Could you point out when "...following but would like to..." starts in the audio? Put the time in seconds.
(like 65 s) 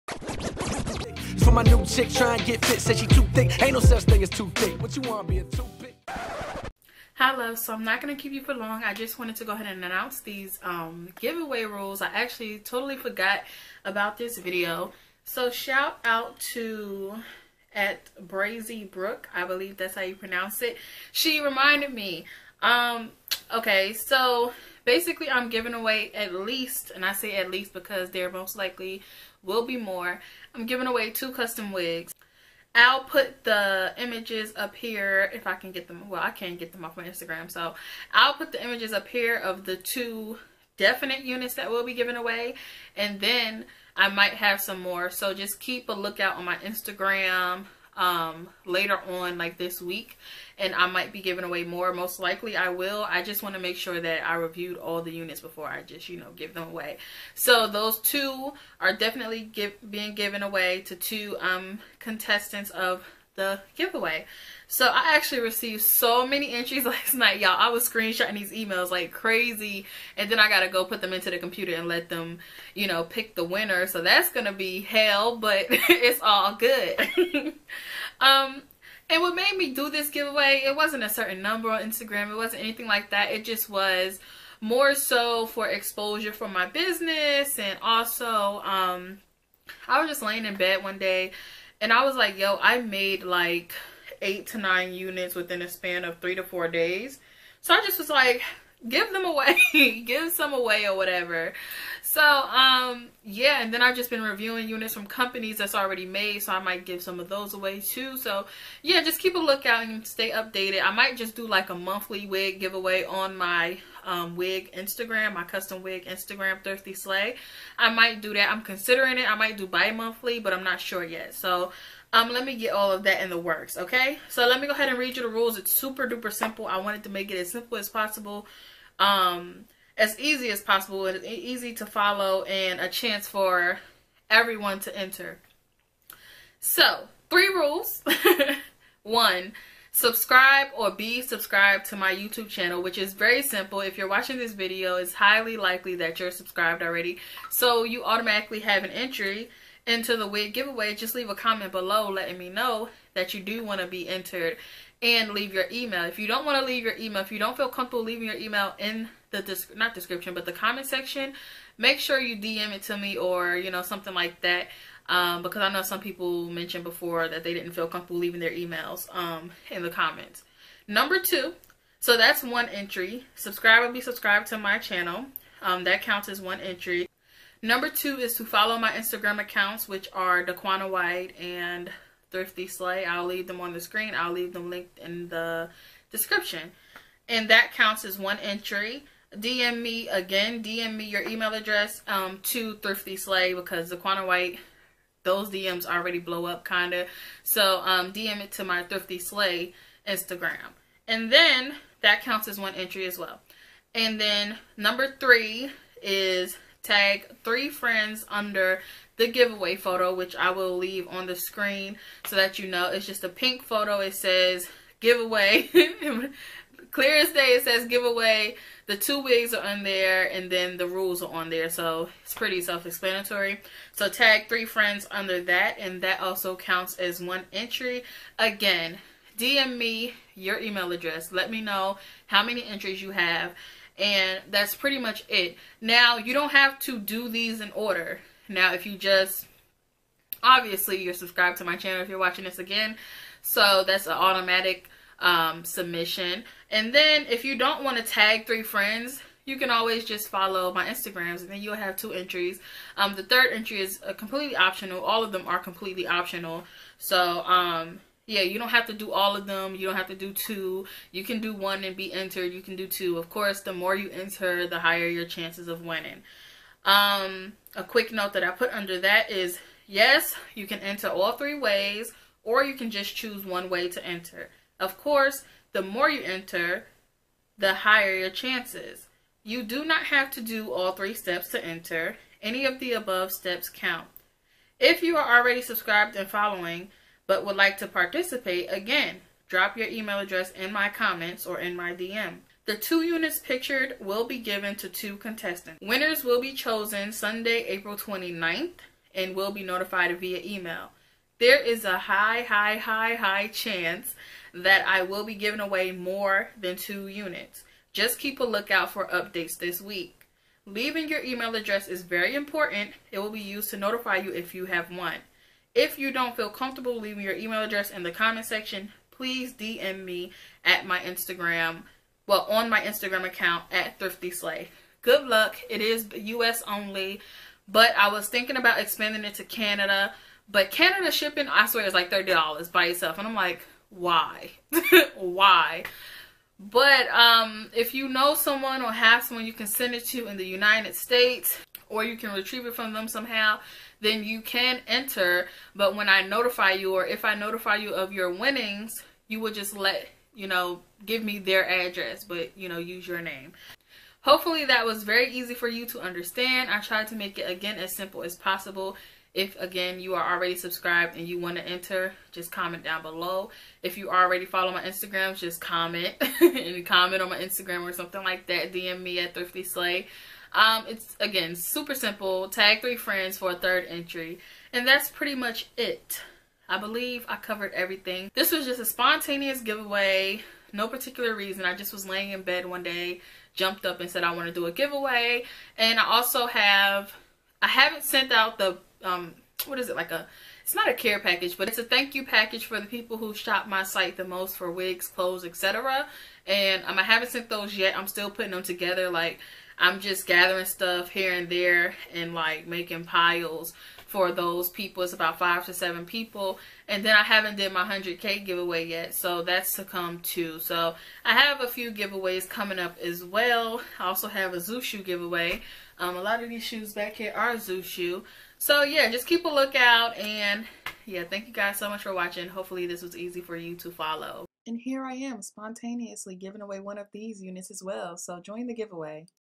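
286 s.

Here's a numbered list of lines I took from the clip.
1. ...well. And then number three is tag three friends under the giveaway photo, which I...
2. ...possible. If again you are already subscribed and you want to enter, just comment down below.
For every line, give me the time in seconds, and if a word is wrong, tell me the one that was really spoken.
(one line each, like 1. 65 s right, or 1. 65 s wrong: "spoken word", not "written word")
1. 203 s right
2. 358 s right.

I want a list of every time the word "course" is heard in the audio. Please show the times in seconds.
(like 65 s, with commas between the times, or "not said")
263 s, 274 s.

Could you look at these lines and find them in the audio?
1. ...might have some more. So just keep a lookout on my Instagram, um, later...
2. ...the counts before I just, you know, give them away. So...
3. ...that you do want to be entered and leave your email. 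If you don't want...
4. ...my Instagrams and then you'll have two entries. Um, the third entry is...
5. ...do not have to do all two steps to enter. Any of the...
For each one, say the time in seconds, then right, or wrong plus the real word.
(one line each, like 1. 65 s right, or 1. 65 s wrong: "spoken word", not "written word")
1. 44 s right
2. 55 s wrong: "units", not "counts"
3. 153 s right
4. 250 s right
5. 279 s wrong: "three", not "two".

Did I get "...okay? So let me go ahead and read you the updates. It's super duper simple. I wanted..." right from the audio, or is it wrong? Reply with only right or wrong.
wrong.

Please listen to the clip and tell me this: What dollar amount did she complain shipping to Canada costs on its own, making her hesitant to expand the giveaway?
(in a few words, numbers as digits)
$30.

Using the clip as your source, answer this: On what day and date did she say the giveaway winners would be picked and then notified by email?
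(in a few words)
Sunday, April 29th.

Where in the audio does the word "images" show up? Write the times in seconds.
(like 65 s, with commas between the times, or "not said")
33 s, 38 s.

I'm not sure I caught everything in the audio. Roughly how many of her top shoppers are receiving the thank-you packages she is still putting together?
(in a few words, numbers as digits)
5 to 7.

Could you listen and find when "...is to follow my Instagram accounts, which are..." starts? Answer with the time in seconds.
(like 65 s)
178 s.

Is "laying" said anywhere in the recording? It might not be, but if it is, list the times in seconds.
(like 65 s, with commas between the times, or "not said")
90 s, 382 s.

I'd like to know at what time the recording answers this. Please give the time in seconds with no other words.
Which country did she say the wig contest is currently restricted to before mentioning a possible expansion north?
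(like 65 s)
326 s.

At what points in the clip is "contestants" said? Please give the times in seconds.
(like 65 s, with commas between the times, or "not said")
61 s, 295 s.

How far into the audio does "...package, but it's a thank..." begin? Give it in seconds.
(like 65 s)
391 s.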